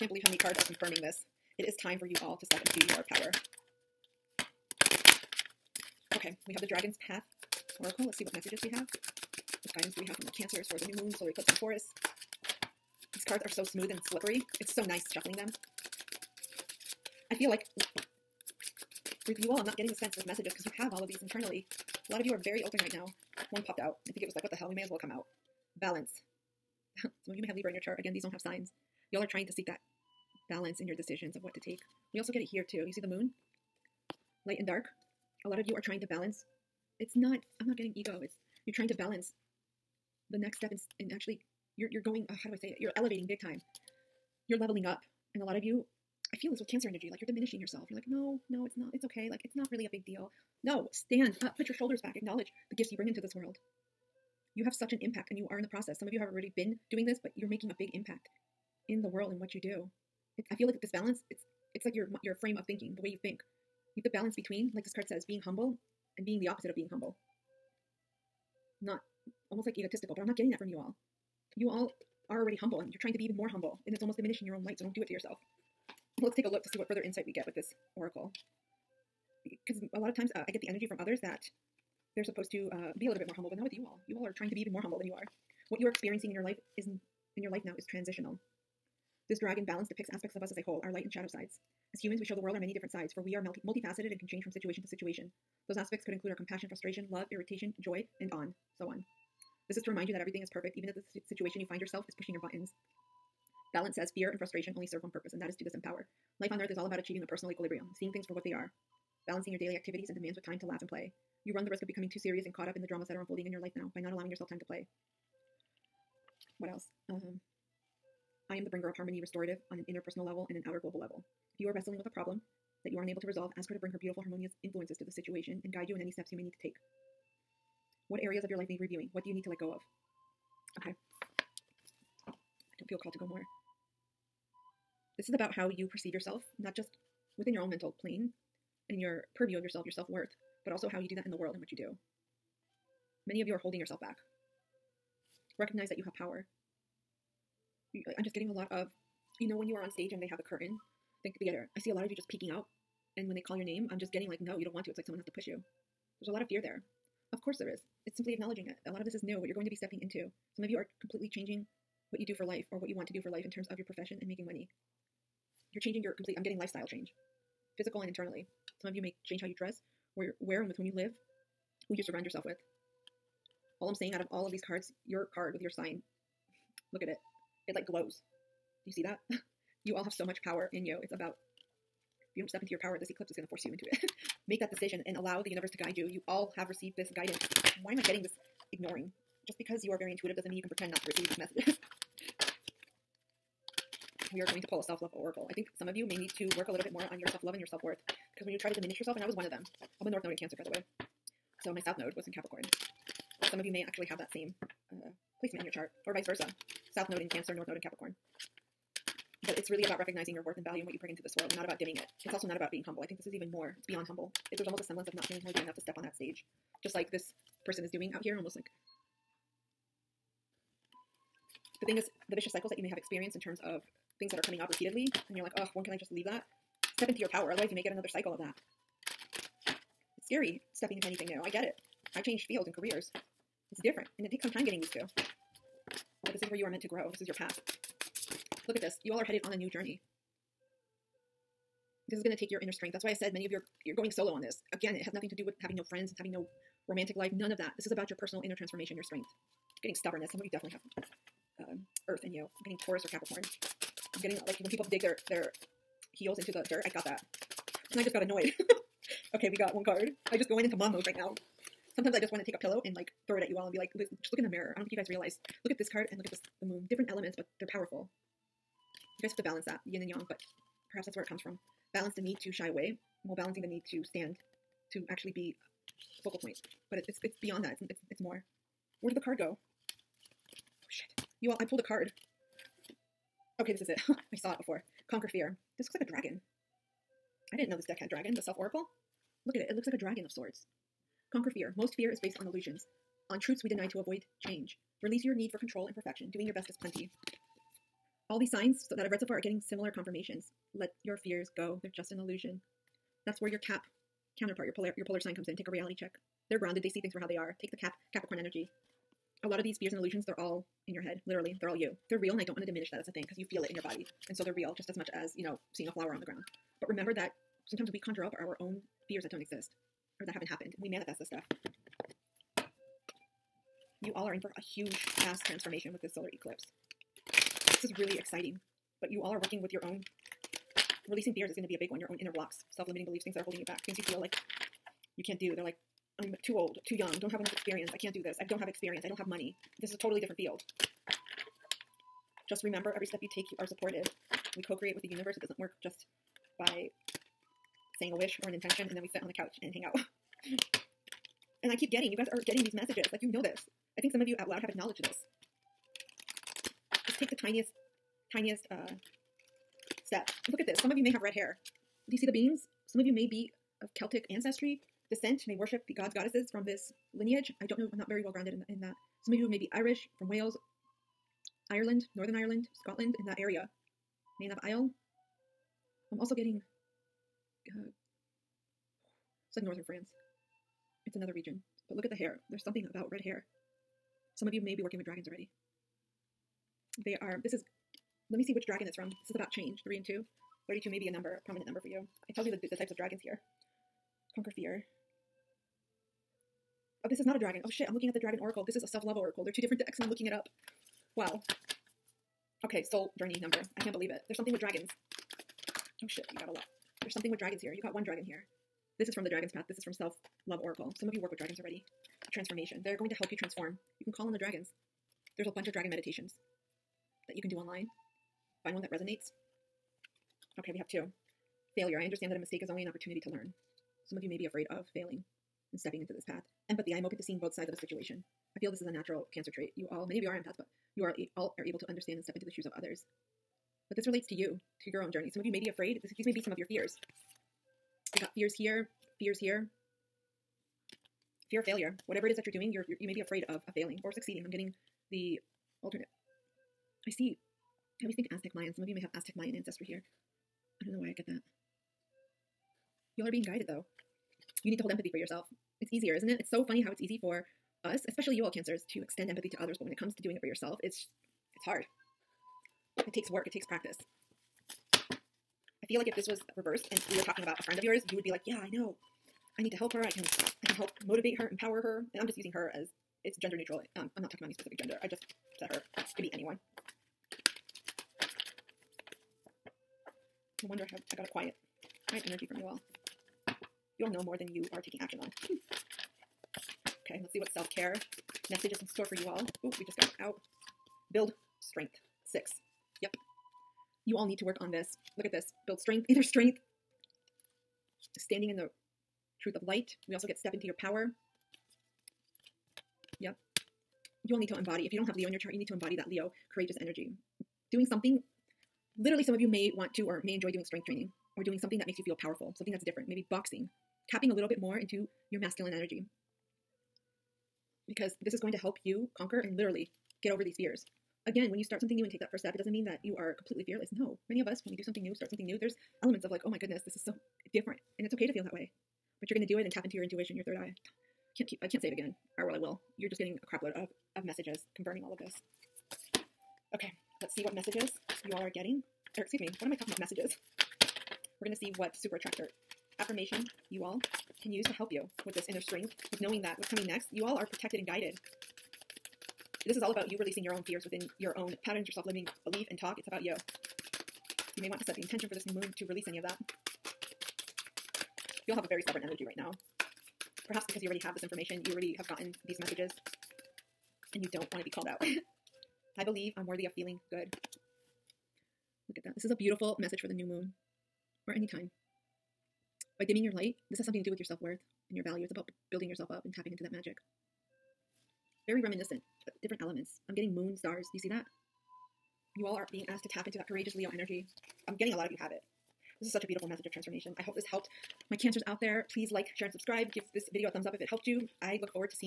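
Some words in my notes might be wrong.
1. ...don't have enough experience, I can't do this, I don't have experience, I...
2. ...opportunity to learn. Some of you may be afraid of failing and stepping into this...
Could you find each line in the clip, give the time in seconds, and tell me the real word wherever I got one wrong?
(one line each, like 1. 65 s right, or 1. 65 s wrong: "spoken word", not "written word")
1. 337 s right
2. 422 s right.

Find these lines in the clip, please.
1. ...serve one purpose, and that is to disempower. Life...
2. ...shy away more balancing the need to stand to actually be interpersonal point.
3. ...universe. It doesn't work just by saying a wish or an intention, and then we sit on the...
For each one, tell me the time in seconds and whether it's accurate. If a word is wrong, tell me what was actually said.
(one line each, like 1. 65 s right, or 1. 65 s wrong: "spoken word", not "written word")
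1. 104 s right
2. 272 s wrong: "focal", not "interpersonal"
3. 345 s right.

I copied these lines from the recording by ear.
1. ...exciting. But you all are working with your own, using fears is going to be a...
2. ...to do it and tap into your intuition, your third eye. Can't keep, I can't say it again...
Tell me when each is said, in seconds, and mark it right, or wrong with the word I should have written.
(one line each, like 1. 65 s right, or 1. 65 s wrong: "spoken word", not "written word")
1. 328 s wrong: "releasing", not "using"
2. 529 s right.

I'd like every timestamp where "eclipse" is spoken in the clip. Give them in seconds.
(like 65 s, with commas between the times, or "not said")
11 s, 183 s, 326 s.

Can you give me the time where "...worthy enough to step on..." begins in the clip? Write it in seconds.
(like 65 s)
215 s.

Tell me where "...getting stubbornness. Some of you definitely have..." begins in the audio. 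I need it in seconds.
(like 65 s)
249 s.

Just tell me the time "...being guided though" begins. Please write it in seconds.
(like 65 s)
453 s.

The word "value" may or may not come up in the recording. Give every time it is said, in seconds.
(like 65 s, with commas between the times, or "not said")
210 s, 575 s.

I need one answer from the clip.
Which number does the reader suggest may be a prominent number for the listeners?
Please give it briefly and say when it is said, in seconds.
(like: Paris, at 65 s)
32, at 390 s.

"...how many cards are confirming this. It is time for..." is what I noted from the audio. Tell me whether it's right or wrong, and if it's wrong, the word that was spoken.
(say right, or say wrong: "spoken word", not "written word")
right.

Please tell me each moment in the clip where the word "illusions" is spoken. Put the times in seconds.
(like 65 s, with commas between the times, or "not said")
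292 s, 302 s, 309 s.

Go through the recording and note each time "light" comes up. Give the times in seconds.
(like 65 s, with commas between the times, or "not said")
34 s, 74 s, 90 s, 499 s, 573 s.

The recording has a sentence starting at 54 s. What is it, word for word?
You have such an impact and you are in the process.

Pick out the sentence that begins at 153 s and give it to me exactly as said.
And when they call your name, I'm just getting like, no, you don't want to.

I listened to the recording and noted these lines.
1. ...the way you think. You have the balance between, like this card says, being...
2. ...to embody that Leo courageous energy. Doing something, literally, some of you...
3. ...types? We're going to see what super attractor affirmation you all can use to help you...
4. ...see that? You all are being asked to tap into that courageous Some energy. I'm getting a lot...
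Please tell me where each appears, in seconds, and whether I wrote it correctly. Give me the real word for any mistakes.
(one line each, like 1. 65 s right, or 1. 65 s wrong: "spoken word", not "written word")
1. 62 s right
2. 505 s right
3. 539 s wrong: "messages", not "types"
4. 580 s wrong: "Leo", not "Some".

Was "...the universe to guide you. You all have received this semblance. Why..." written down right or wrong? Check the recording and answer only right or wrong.
wrong.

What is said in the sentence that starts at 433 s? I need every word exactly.
But this relates to you, to your own journey.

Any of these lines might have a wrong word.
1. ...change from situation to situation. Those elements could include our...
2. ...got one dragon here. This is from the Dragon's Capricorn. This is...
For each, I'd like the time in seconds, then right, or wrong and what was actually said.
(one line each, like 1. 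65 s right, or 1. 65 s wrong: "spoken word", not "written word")
1. 94 s wrong: "aspects", not "elements"
2. 407 s wrong: "Path", not "Capricorn".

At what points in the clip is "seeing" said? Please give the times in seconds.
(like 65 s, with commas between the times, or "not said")
107 s, 315 s, 427 s.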